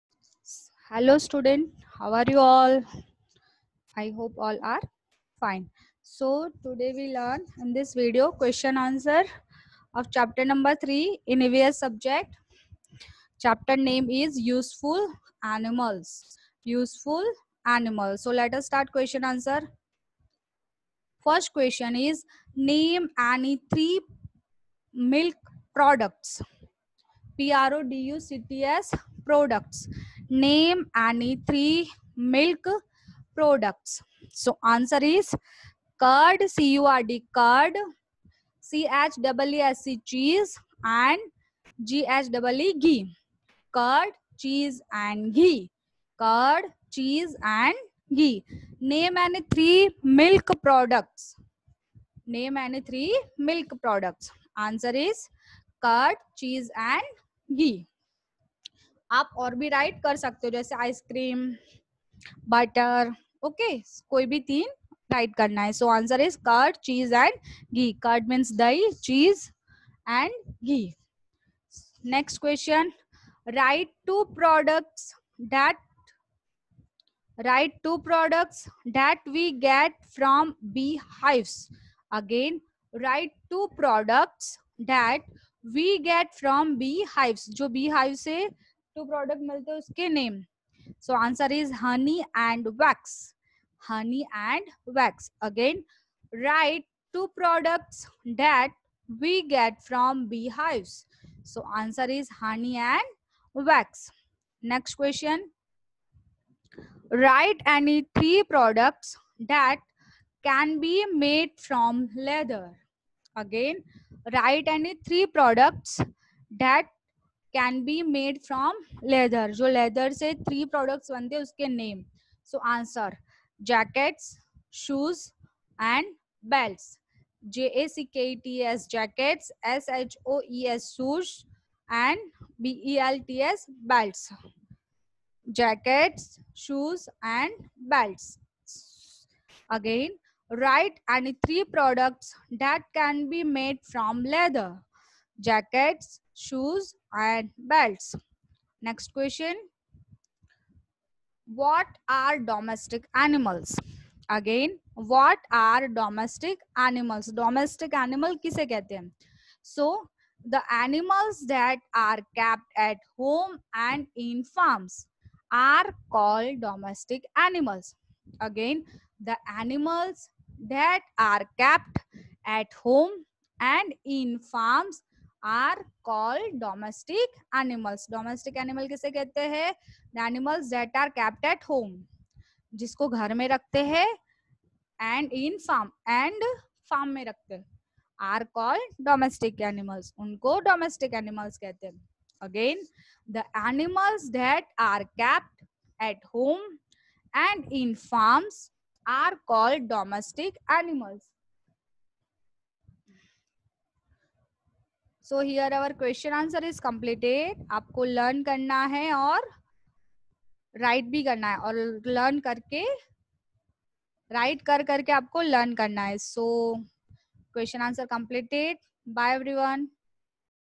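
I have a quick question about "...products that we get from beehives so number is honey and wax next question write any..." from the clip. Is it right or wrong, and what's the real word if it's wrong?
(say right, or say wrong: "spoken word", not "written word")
wrong: "answer", not "number".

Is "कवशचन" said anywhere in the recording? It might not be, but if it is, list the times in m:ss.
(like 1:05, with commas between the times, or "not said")
1:12, 3:25, 3:37.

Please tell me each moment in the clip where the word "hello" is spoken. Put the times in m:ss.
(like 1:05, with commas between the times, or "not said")
0:00.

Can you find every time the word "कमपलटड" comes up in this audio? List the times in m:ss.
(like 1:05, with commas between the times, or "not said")
3:26, 3:38.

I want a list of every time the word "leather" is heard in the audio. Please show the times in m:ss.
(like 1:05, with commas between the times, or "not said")
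1:52, 2:24.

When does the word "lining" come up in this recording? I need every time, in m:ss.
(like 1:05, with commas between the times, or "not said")
not said.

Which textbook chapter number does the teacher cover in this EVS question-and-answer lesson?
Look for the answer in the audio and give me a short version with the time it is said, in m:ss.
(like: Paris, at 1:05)
3, at 0:10.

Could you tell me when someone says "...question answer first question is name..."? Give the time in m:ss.
0:18.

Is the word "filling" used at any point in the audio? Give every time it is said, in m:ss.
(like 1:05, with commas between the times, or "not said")
not said.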